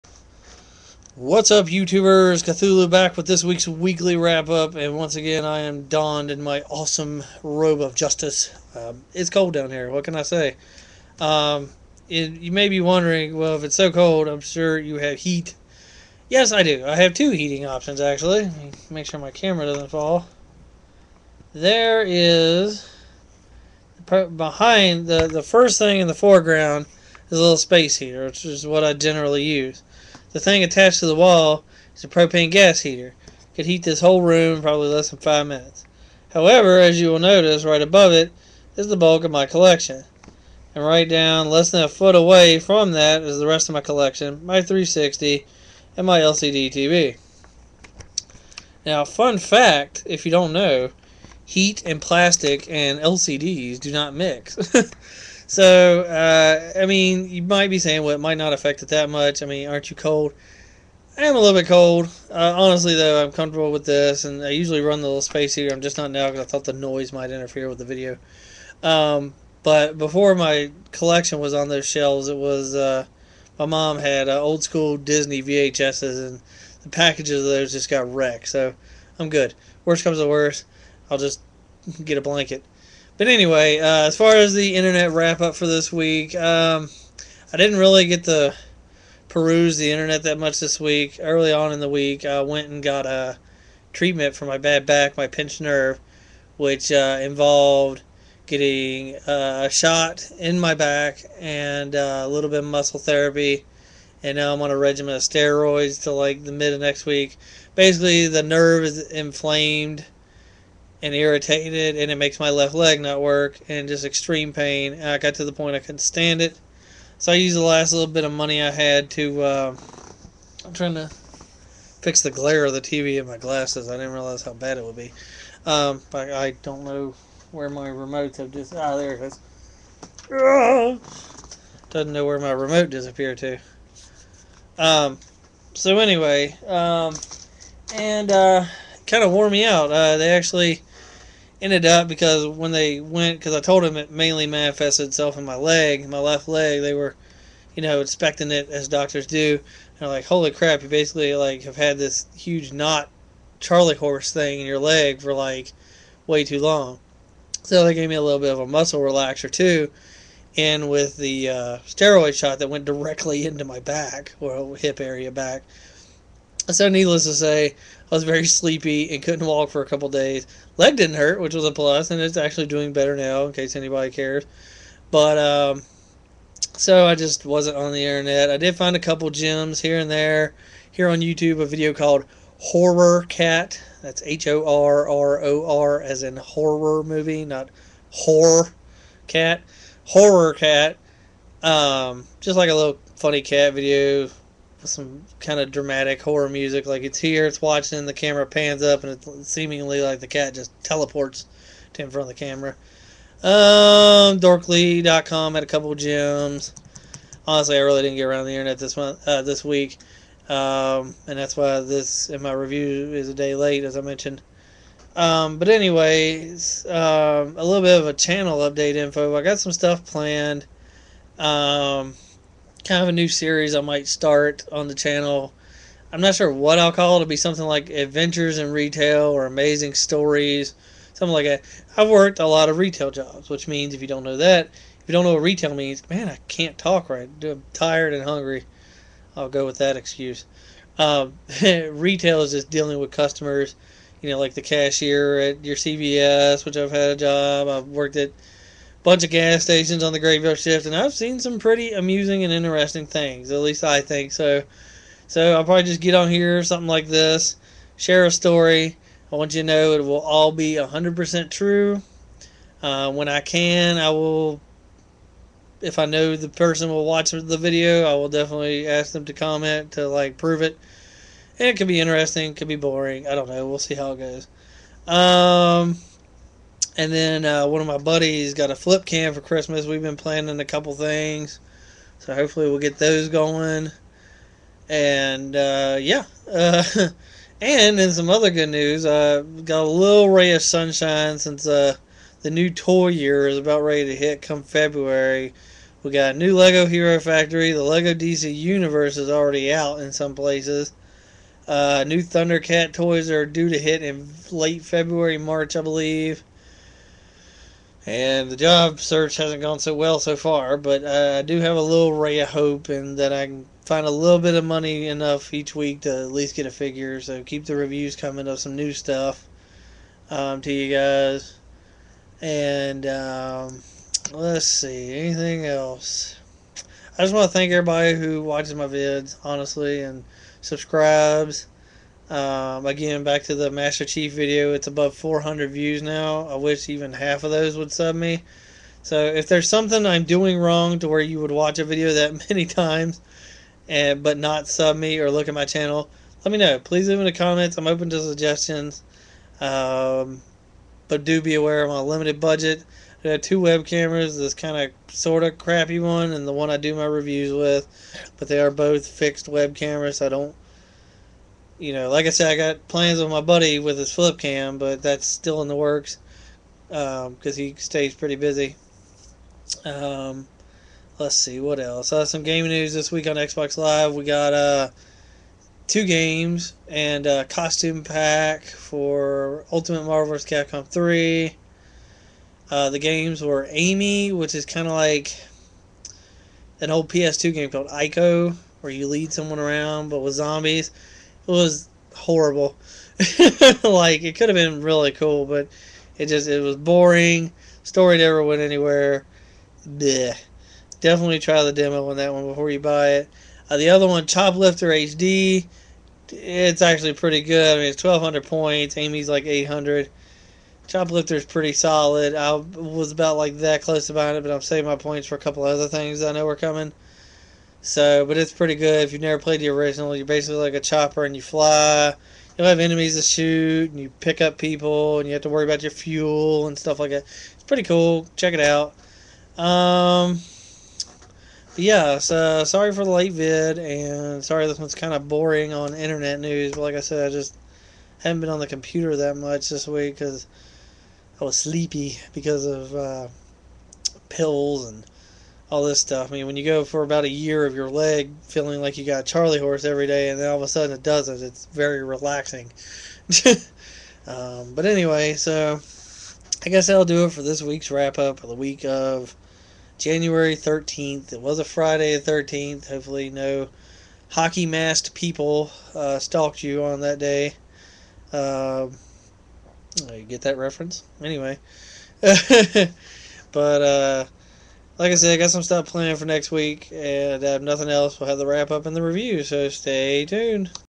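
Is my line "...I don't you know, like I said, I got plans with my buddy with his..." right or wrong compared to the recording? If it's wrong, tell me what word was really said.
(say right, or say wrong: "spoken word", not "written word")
right.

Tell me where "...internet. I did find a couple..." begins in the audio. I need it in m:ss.
2:58.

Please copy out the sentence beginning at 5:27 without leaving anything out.
I just want to thank everybody who watches my vids, honestly, and subscribes.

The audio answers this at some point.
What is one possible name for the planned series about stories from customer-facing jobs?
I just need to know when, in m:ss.
3:47.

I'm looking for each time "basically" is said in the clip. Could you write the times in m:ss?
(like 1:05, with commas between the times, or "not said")
1:47, 2:30, 7:00.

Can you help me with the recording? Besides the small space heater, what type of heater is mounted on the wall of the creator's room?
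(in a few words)
Propane gas heater.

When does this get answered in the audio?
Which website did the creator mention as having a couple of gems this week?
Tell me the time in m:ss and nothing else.
3:24.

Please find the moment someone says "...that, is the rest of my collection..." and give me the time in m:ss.
0:42.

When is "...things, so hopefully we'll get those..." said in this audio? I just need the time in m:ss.
4:40.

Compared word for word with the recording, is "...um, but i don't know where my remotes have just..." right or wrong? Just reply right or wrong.
right.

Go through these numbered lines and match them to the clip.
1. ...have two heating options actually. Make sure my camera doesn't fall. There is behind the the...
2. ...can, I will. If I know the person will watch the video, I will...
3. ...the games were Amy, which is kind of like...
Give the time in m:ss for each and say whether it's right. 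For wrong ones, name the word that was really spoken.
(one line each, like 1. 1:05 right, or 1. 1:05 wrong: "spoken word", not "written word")
1. 0:16 right
2. 4:23 right
3. 6:22 right.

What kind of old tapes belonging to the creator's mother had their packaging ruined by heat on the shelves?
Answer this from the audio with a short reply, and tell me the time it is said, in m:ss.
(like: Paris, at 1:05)
Disney VHSs, at 1:14.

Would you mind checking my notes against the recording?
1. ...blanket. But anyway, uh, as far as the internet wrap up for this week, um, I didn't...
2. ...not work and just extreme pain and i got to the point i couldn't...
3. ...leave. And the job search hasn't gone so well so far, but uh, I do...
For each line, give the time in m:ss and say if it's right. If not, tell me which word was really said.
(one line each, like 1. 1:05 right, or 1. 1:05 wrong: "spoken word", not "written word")
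1. 1:22 right
2. 1:53 right
3. 5:05 wrong: "believe", not "leave".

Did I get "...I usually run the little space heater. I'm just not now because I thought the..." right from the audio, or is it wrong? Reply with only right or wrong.
right.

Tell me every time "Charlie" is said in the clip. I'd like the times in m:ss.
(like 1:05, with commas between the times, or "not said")
2:33, 7:29.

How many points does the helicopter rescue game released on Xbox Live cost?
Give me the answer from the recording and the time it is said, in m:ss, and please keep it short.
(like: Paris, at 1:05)
1,200, at 6:48.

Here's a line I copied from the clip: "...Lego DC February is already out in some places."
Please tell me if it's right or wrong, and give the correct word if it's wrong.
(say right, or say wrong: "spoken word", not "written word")
wrong: "Universe", not "February".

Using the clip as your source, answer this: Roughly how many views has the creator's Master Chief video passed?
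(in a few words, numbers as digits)
400.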